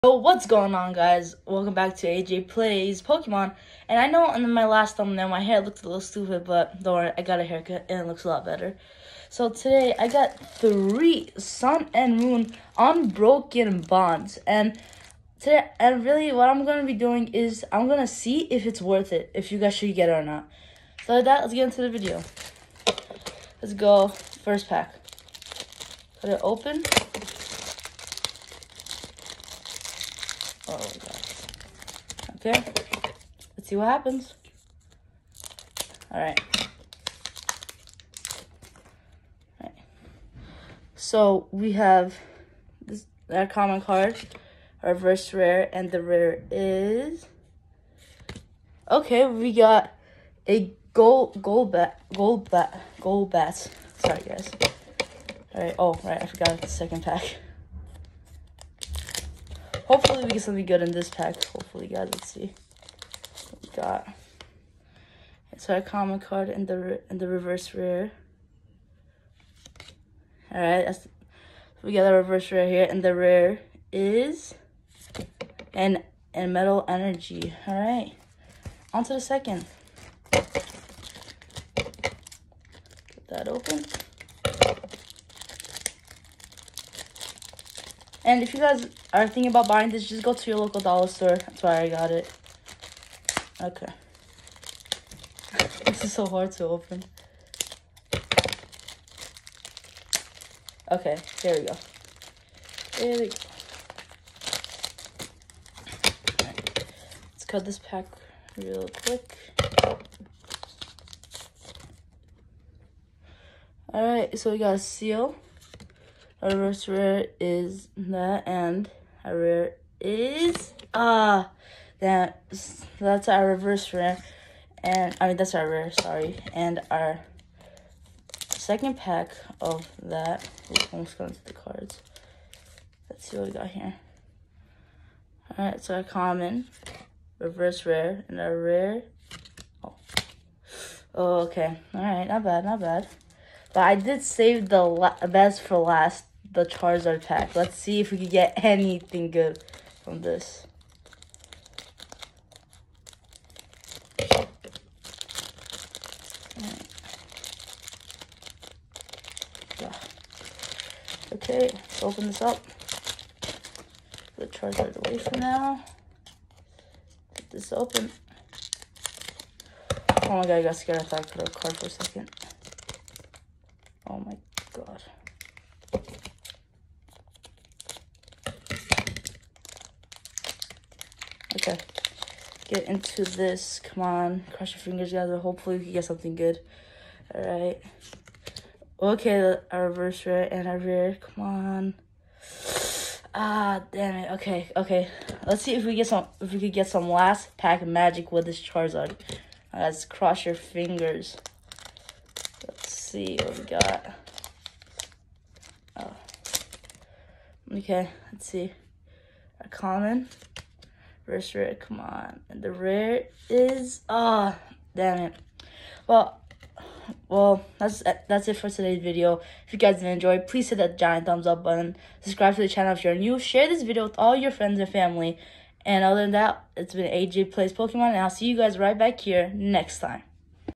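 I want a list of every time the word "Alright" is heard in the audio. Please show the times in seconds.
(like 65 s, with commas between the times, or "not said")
113 s, 187 s.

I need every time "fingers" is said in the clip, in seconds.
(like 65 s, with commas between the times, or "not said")
184 s, 200 s.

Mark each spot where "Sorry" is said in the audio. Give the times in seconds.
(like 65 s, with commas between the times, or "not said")
53 s, 125 s.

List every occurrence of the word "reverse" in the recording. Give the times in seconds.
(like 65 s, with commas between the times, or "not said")
44 s, 67 s, 72 s, 116 s, 123 s, 137 s, 189 s.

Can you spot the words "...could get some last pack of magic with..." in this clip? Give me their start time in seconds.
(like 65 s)
196 s.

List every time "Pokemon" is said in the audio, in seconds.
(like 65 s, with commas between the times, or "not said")
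3 s, 227 s.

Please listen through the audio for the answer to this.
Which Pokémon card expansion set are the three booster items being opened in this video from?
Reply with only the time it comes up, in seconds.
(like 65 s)
12 s.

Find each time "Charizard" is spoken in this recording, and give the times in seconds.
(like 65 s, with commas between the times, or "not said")
146 s, 164 s, 198 s.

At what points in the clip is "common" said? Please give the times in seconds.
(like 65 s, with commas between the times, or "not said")
43 s, 65 s, 136 s, 209 s.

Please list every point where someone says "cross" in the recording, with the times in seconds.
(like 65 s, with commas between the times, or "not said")
184 s, 200 s.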